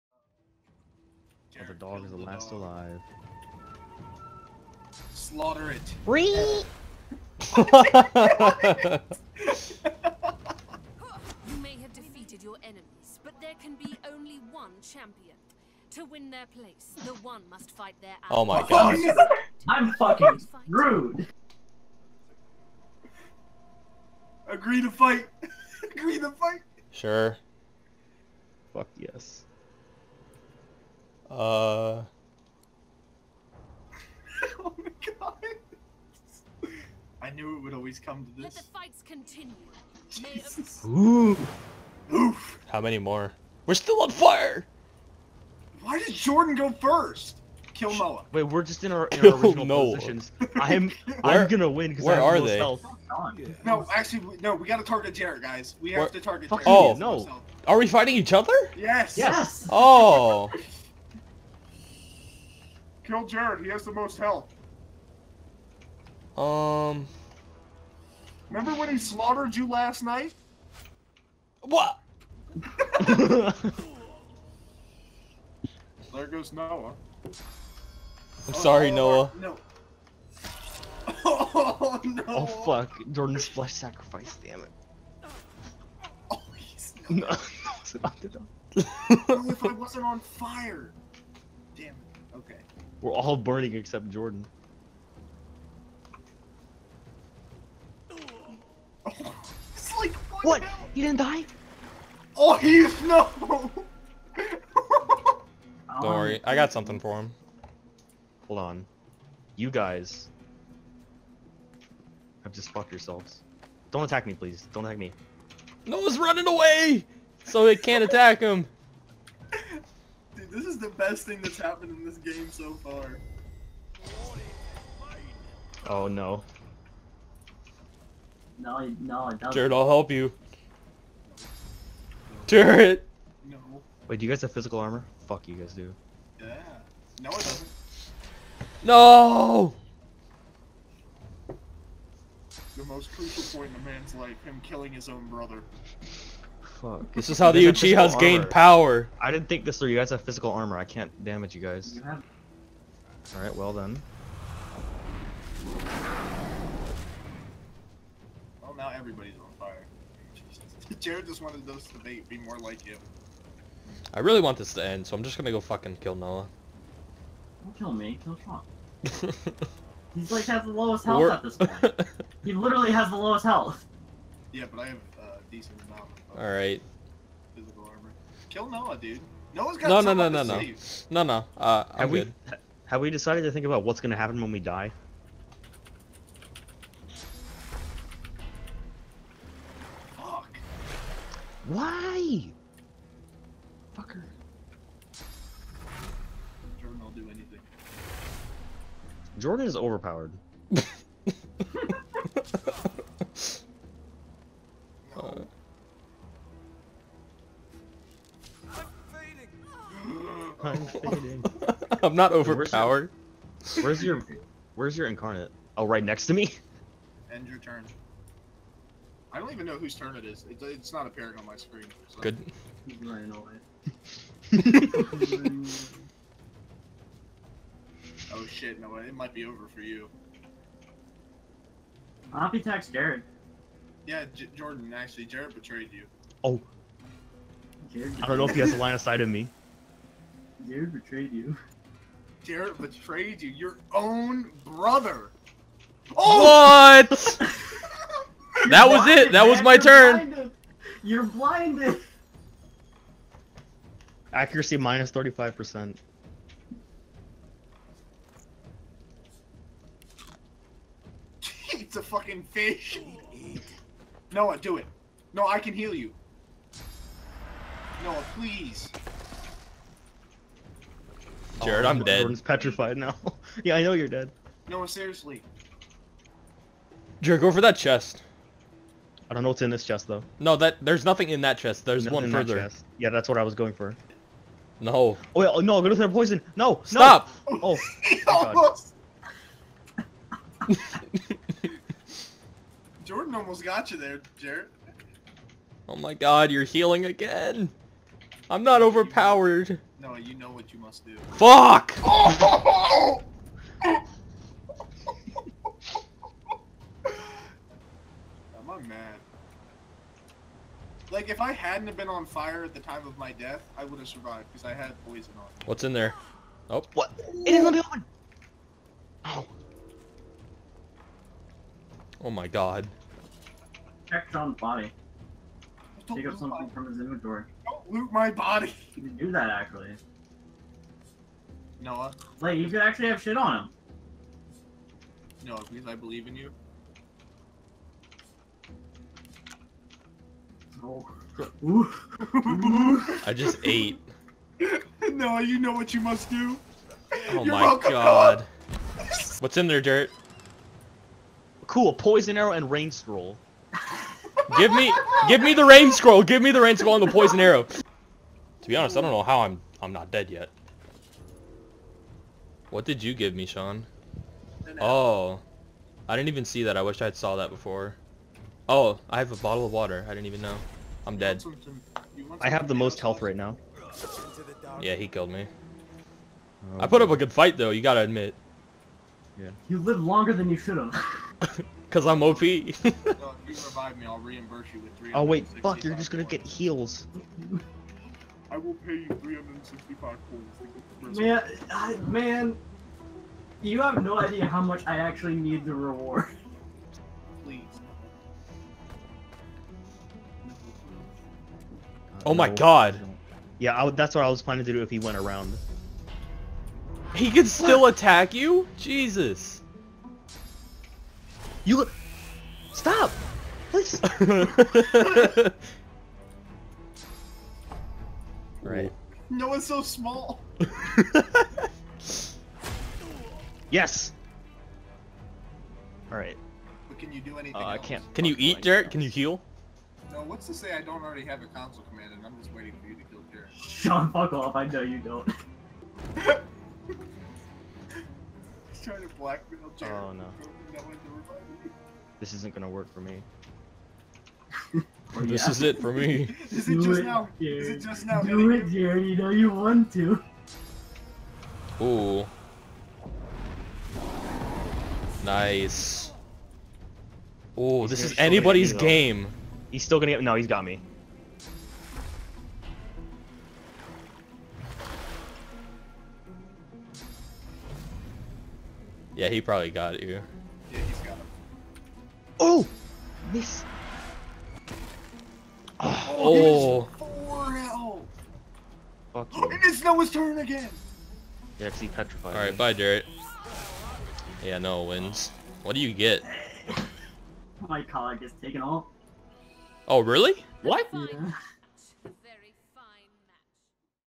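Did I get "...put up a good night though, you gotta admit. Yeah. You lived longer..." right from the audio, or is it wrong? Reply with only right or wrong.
wrong.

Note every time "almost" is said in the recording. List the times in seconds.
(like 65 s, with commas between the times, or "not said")
288 s, 293 s.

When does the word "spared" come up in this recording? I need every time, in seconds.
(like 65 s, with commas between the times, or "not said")
not said.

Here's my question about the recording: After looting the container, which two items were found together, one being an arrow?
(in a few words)
Poison arrow and rain scroll.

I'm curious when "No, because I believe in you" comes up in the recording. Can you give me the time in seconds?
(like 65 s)
335 s.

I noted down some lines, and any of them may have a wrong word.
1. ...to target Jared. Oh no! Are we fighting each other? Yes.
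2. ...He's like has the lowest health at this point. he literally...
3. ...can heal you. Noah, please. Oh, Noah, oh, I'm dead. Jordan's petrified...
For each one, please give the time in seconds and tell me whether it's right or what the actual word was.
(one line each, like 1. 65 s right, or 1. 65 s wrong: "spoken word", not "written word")
1. 56 s right
2. 170 s right
3. 265 s wrong: "Jared", not "Noah".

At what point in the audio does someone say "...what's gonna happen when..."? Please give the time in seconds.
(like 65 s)
183 s.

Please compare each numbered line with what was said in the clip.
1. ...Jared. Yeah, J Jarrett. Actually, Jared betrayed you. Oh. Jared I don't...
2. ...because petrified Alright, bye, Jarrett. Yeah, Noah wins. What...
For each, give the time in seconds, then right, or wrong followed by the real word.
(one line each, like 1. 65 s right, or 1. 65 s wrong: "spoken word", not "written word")
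1. 232 s wrong: "Jordan", not "Jarrett"
2. 481 s right.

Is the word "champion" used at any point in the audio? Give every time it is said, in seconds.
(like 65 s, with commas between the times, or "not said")
14 s.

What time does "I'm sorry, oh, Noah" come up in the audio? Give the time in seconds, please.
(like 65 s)
78 s.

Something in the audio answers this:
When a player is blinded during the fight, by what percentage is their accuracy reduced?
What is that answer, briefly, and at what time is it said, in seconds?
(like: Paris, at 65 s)
35%, at 255 s.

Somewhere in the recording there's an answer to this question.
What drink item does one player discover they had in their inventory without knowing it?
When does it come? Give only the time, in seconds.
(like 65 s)
369 s.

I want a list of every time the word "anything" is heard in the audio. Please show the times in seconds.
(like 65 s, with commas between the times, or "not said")
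197 s, 427 s.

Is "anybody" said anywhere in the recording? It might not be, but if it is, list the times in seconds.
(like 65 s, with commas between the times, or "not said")
458 s.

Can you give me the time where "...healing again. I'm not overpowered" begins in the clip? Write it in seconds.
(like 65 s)
296 s.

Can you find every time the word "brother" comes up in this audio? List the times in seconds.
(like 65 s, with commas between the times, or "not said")
145 s, 244 s.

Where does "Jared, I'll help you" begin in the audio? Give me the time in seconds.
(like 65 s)
129 s.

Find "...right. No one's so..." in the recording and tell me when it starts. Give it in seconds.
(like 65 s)
418 s.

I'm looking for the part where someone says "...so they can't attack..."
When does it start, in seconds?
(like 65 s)
117 s.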